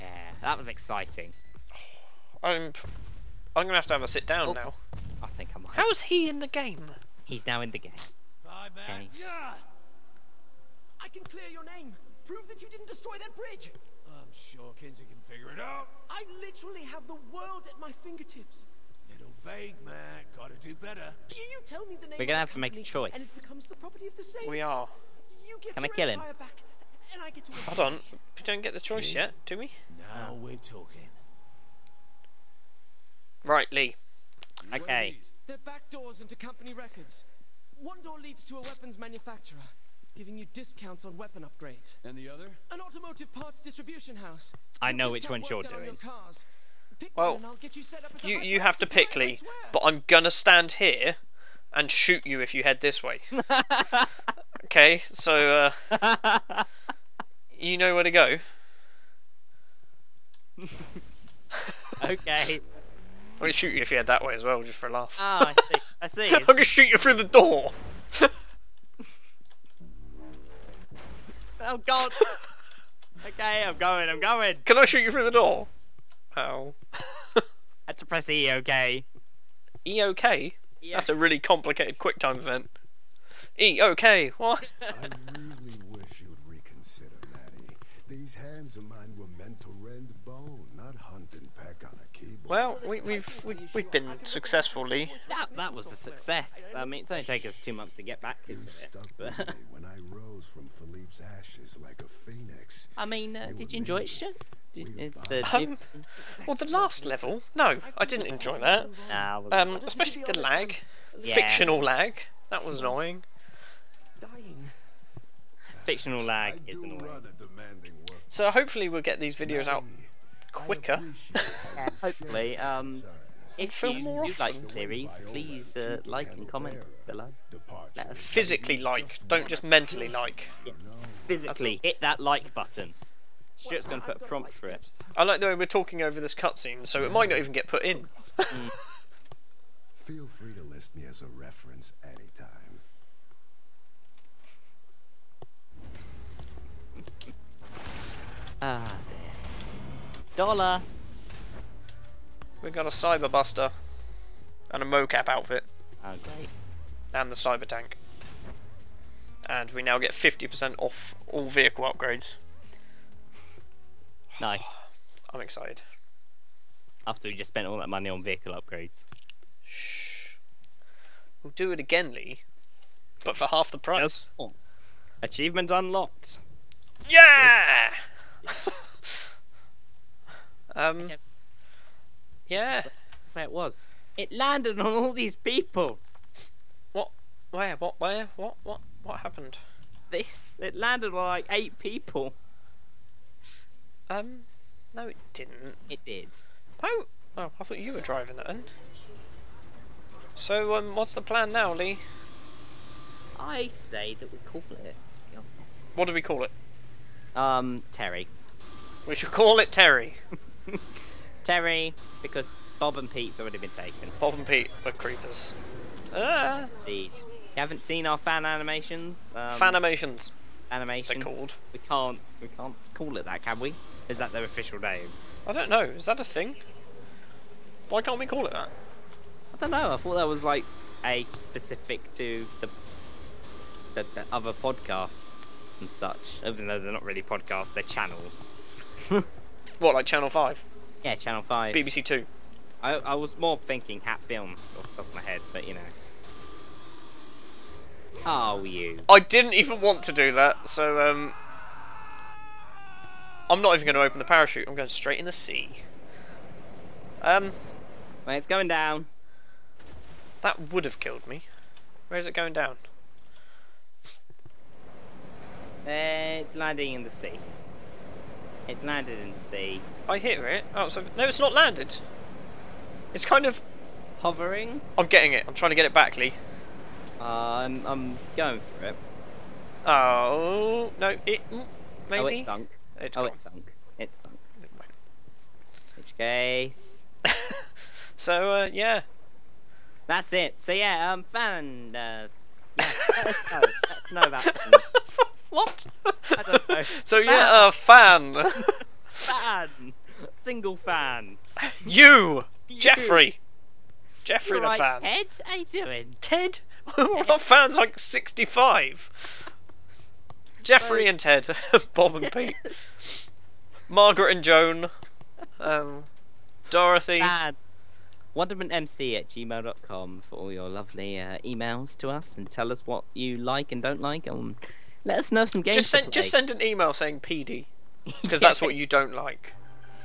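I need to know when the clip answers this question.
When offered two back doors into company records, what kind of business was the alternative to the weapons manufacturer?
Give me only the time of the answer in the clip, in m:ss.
0:42.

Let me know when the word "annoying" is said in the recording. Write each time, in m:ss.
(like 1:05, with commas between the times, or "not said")
1:52, 1:56.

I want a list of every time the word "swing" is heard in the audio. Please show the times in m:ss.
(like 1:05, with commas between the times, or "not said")
not said.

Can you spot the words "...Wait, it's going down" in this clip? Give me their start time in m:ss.
4:18.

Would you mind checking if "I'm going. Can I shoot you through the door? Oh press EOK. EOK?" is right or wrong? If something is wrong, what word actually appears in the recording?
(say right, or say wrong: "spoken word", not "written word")
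right.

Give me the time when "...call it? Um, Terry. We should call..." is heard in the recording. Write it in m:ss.
3:26.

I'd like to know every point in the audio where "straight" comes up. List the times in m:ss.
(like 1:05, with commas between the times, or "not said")
4:14.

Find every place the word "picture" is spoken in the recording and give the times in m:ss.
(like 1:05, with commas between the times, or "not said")
not said.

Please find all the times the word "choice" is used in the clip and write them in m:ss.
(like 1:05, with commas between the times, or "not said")
0:22, 0:28.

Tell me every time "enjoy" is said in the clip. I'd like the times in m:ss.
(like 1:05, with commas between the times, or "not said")
1:43, 1:48.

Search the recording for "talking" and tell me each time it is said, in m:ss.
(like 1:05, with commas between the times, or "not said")
0:30, 2:15.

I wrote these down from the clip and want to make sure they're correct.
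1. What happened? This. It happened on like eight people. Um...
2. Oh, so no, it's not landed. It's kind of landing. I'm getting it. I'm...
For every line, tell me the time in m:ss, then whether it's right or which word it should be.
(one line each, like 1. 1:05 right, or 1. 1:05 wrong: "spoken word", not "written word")
1. 3:09 wrong: "landed", not "happened"
2. 4:30 wrong: "hovering", not "landing".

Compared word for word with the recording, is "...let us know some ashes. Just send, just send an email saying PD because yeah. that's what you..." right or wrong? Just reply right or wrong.
wrong.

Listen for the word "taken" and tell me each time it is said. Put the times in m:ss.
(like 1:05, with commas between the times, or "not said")
1:37, 3:33.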